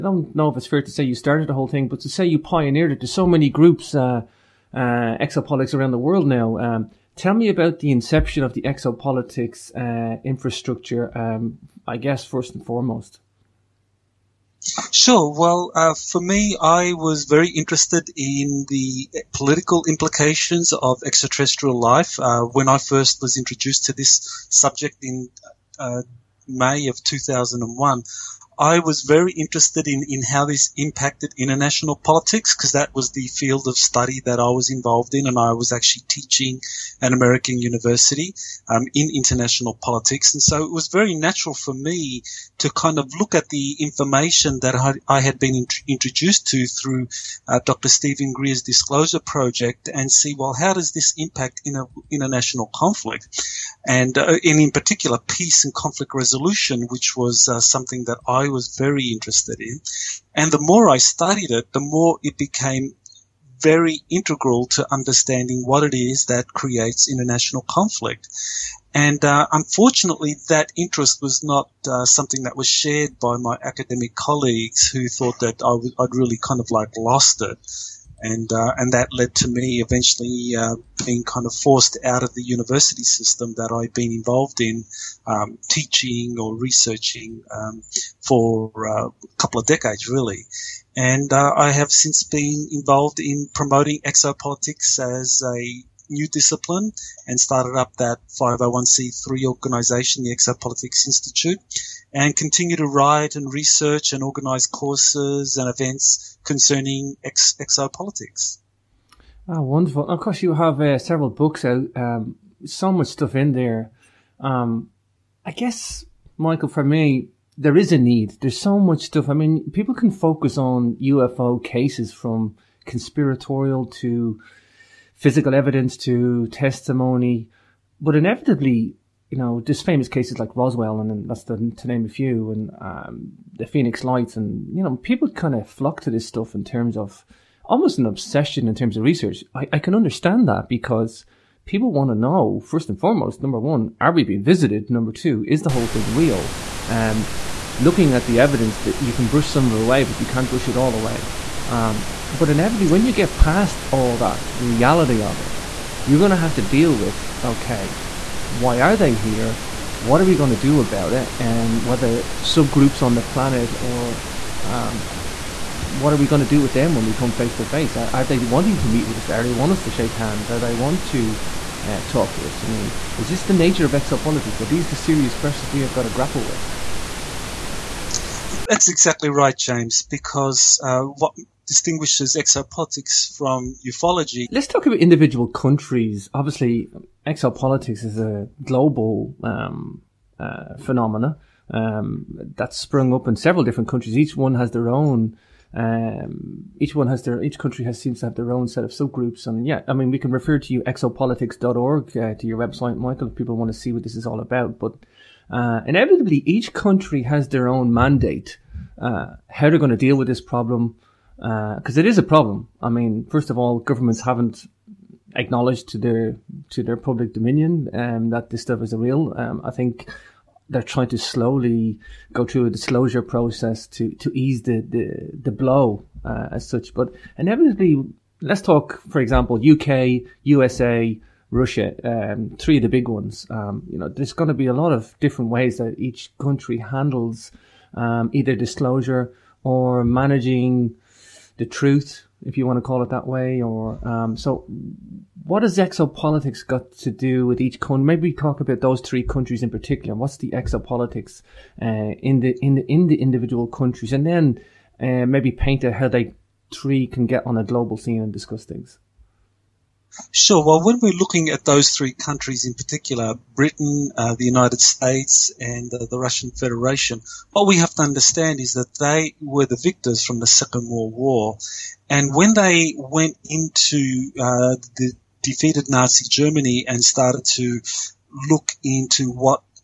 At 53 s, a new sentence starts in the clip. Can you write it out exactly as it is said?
And, uh, in particular, peace and conflict resolution, which was uh, something that I was very interested in.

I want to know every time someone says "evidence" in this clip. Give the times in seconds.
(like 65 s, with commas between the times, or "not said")
125 s, 148 s.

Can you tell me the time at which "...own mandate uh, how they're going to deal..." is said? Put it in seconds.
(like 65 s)
207 s.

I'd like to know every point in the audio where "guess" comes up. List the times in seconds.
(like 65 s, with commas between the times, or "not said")
11 s, 115 s.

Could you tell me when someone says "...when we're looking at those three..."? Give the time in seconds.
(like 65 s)
260 s.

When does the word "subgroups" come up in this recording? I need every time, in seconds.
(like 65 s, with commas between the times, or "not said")
162 s, 198 s.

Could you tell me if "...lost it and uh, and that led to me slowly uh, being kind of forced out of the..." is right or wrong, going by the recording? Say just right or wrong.
wrong.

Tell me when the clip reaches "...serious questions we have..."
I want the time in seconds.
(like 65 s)
174 s.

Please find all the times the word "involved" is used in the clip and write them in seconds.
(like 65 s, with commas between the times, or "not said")
34 s, 84 s, 92 s.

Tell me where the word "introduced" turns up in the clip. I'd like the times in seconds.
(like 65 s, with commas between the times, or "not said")
23 s, 45 s.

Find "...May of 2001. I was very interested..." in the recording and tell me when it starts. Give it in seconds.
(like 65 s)
26 s.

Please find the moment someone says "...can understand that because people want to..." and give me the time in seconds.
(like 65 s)
139 s.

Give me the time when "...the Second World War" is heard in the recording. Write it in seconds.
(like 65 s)
270 s.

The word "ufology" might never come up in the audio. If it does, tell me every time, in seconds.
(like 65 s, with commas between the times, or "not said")
183 s.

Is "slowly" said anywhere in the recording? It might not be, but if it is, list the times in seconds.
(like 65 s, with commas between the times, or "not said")
221 s.